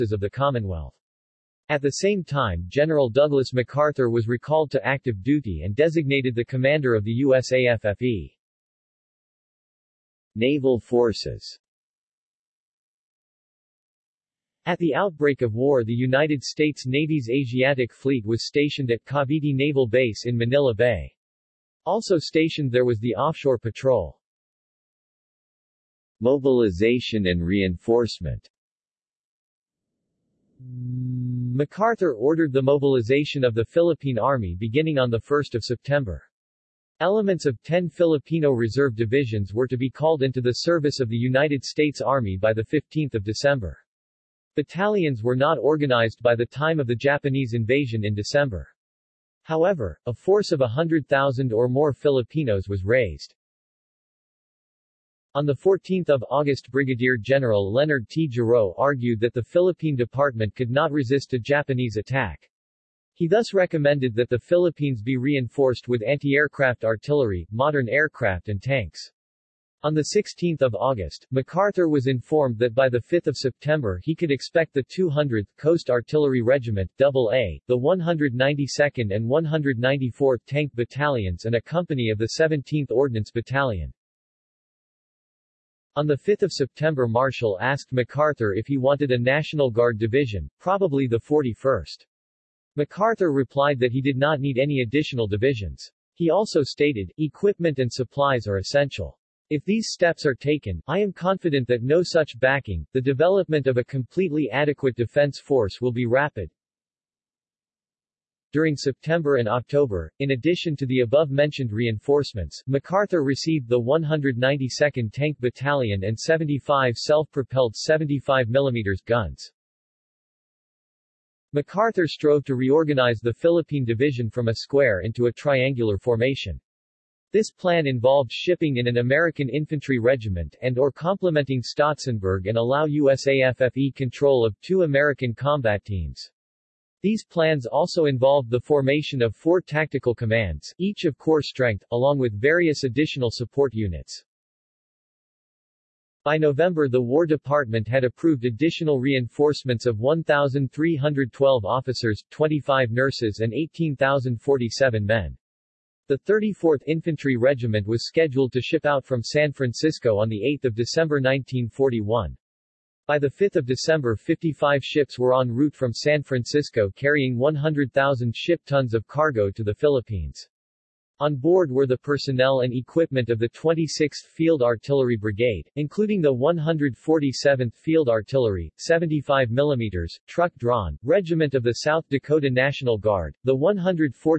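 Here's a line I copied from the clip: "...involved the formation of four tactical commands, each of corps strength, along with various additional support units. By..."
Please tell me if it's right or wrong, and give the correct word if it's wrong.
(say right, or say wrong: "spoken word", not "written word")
right.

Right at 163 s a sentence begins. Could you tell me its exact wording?
By 5 December 55 ships were en route from San Francisco carrying 100,000 ship tons of cargo to the Philippines.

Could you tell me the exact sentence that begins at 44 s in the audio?
Battalions were not organized by the time of the Japanese invasion in December.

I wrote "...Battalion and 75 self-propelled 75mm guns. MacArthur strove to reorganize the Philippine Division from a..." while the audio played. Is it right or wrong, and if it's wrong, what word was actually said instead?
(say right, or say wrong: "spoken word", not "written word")
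right.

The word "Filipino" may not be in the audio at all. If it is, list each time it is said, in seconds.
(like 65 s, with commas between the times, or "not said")
37 s, 51 s.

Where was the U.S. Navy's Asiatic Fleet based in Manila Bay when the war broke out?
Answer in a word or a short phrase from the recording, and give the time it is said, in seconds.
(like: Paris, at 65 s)
Cavite Naval Base, at 19 s.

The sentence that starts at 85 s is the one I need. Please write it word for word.
On 5 September Marshall asked MacArthur if he wanted a National Guard division, probably the 41st.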